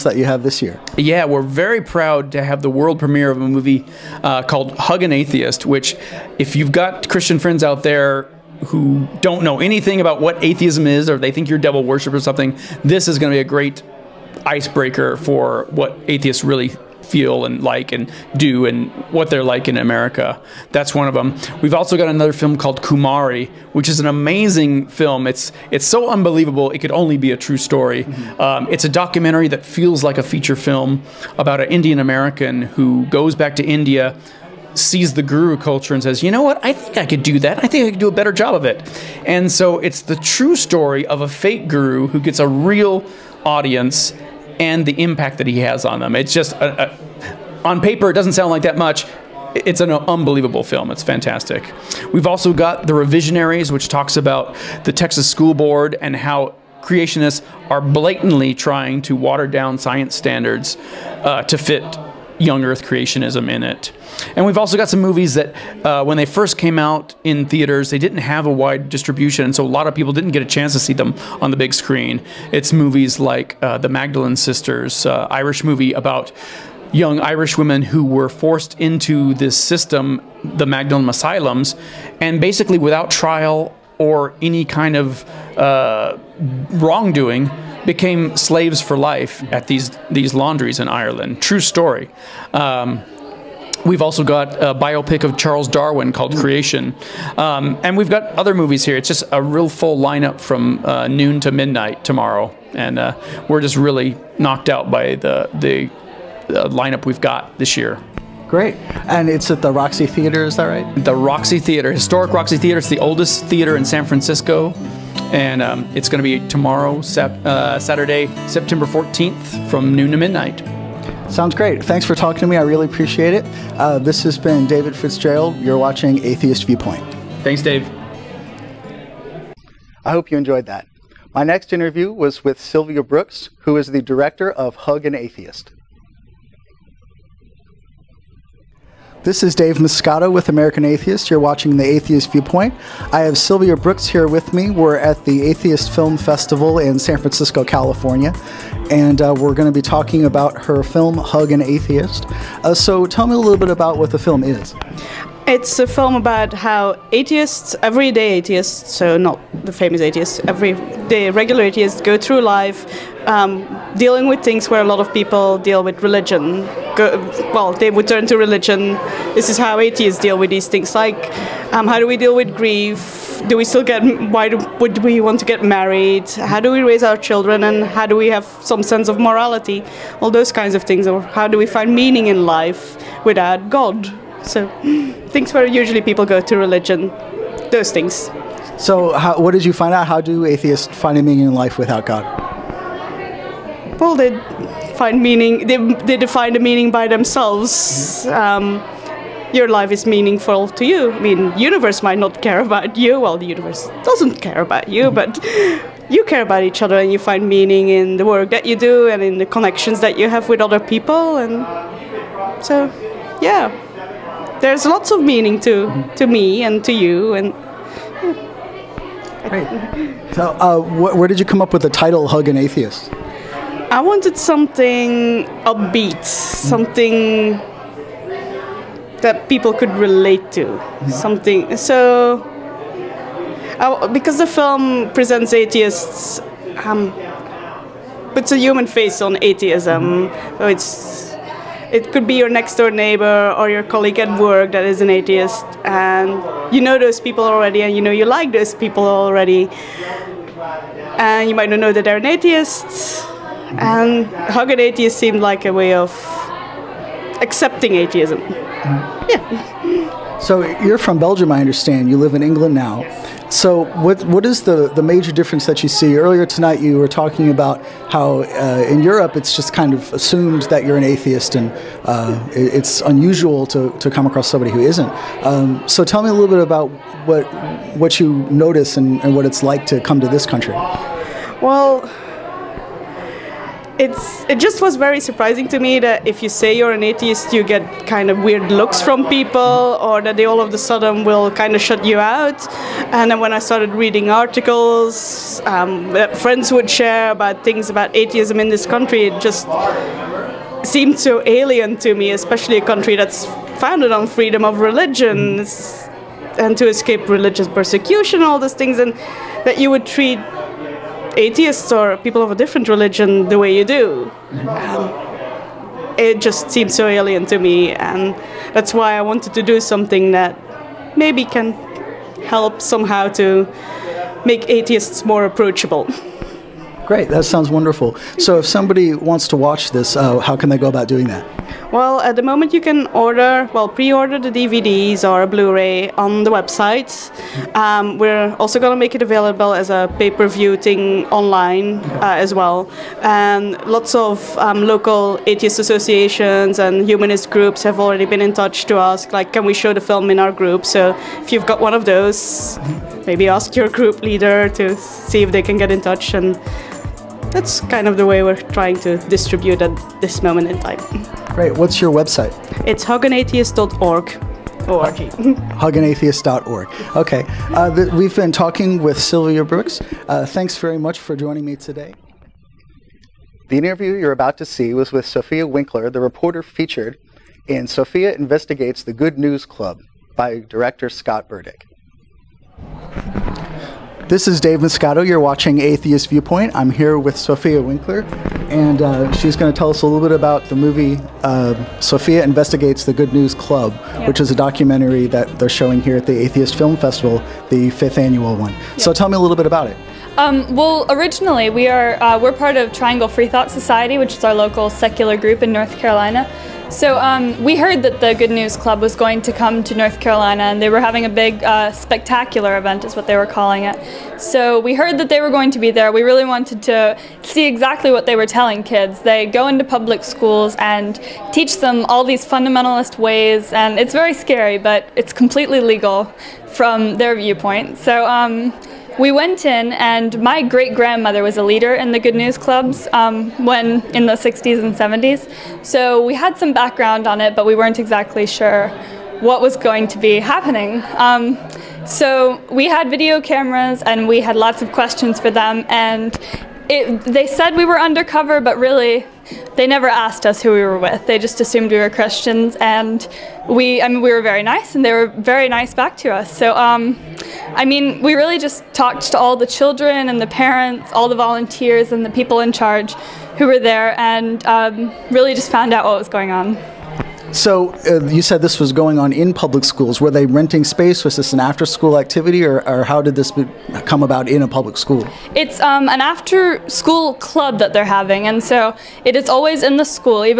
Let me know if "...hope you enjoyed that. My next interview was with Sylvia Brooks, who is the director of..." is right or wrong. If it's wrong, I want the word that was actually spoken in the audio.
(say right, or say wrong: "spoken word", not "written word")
right.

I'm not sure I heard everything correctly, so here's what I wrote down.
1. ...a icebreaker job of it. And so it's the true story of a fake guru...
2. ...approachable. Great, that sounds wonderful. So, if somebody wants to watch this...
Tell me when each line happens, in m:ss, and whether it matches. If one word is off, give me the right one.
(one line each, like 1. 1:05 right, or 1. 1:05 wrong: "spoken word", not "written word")
1. 0:38 wrong: "better", not "icebreaker"
2. 5:25 right.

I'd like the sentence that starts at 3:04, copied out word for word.
So things where usually people go to religion, those things.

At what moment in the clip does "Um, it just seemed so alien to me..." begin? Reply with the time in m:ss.
5:14.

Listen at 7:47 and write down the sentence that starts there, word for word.
So uh, you said this was going on in public schools.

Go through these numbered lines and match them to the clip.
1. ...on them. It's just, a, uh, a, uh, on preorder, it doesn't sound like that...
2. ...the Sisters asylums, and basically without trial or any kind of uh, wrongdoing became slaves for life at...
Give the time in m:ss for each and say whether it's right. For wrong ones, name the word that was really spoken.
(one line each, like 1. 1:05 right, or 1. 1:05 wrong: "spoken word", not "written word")
1. 0:45 wrong: "paper", not "preorder"
2. 1:20 wrong: "Magdalene", not "Sisters".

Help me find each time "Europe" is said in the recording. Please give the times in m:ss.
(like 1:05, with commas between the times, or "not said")
4:29.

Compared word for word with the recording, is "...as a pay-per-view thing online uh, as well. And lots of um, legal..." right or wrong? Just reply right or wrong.
wrong.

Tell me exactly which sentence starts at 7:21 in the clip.
Um, so we had video cameras, and we had lots of questions for them, and.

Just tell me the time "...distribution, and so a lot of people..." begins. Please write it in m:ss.
1:08.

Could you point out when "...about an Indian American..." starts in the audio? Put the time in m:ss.
0:31.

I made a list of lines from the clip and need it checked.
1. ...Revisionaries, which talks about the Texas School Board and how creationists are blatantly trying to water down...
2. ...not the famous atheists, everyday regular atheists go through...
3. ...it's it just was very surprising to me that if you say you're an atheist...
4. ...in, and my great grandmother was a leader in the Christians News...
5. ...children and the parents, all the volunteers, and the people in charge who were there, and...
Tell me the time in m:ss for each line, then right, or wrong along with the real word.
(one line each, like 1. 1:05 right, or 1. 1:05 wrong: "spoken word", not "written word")
1. 0:52 right
2. 2:39 right
3. 4:43 right
4. 7:09 wrong: "Good", not "Christians"
5. 7:39 right.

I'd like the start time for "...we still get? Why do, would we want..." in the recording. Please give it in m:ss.
2:53.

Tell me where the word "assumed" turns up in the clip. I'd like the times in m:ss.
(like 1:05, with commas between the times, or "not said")
4:30, 7:31.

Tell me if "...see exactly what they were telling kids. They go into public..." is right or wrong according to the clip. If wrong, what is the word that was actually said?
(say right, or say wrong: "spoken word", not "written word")
right.